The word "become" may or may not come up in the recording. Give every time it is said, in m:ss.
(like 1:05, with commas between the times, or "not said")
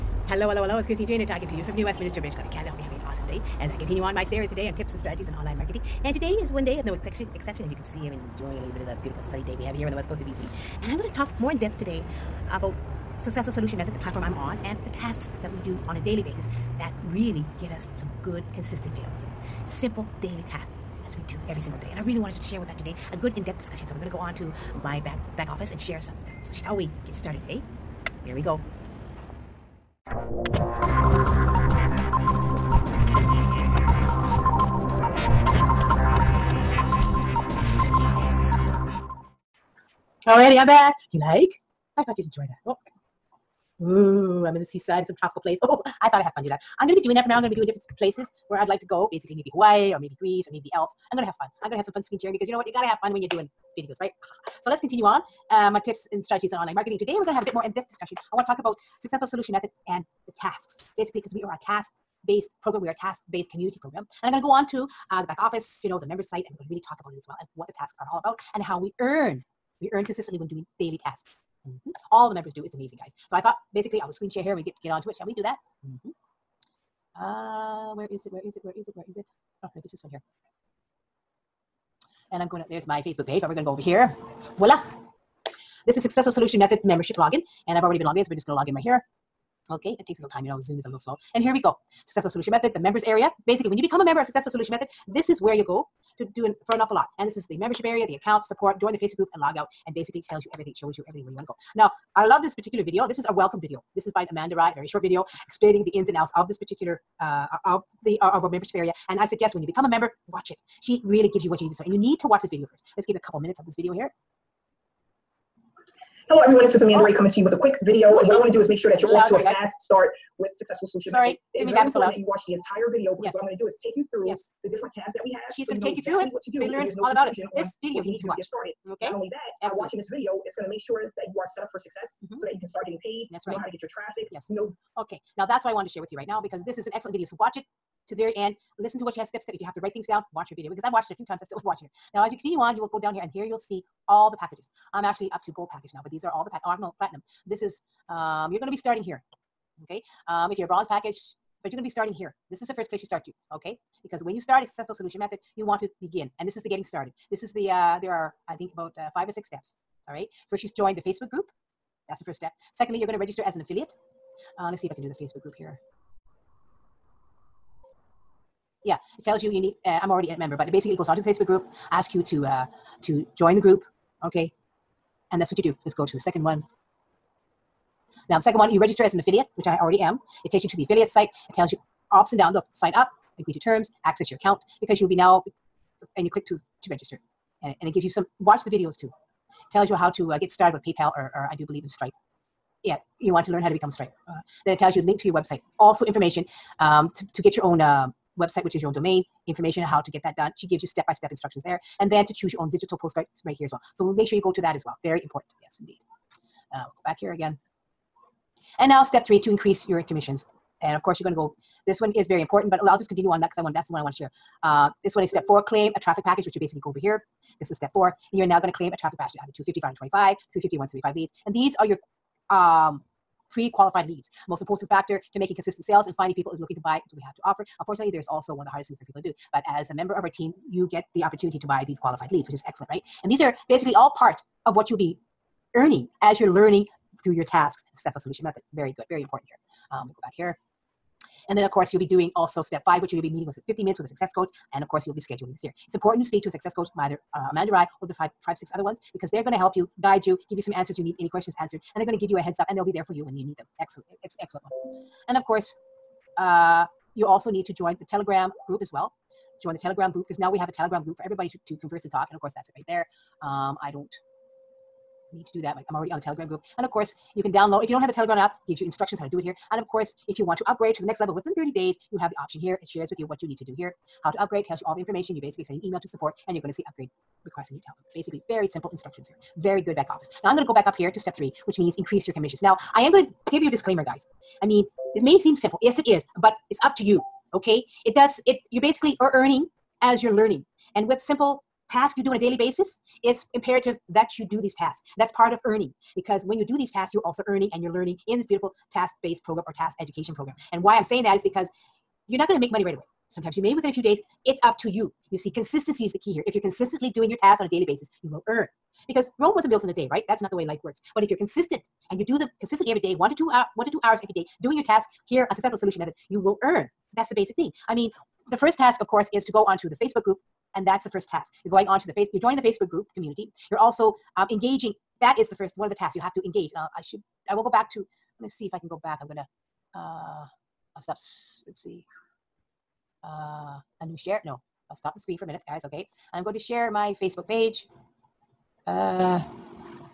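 1:33, 1:49, 3:13.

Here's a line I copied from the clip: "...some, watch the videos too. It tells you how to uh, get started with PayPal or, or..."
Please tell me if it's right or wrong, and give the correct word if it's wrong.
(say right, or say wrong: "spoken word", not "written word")
right.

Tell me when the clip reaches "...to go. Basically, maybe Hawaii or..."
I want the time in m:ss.
0:48.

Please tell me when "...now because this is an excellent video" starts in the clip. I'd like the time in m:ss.
2:16.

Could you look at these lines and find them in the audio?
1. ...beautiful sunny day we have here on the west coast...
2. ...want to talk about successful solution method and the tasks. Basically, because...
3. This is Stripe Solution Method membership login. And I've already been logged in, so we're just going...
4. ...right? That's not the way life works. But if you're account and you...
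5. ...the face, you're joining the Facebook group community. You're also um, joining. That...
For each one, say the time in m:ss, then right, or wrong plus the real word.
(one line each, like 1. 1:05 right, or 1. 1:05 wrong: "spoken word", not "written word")
1. 0:09 right
2. 0:58 right
3. 1:25 wrong: "Successful", not "Stripe"
4. 5:10 wrong: "consistent", not "account"
5. 5:22 wrong: "engaging", not "joining".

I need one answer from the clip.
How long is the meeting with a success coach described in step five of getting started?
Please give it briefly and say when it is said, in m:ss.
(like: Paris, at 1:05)
50 minutes, at 4:03.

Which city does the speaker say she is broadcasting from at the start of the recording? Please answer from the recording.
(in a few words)
New Westminster.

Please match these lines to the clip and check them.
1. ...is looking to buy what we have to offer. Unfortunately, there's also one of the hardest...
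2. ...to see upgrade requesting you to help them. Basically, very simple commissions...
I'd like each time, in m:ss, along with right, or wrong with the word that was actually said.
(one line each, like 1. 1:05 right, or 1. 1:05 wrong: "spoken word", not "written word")
1. 3:46 right
2. 4:36 wrong: "instructions", not "commissions".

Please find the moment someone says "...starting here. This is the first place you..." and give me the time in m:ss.
2:31.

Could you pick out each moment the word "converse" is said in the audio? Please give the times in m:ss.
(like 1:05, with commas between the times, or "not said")
4:21.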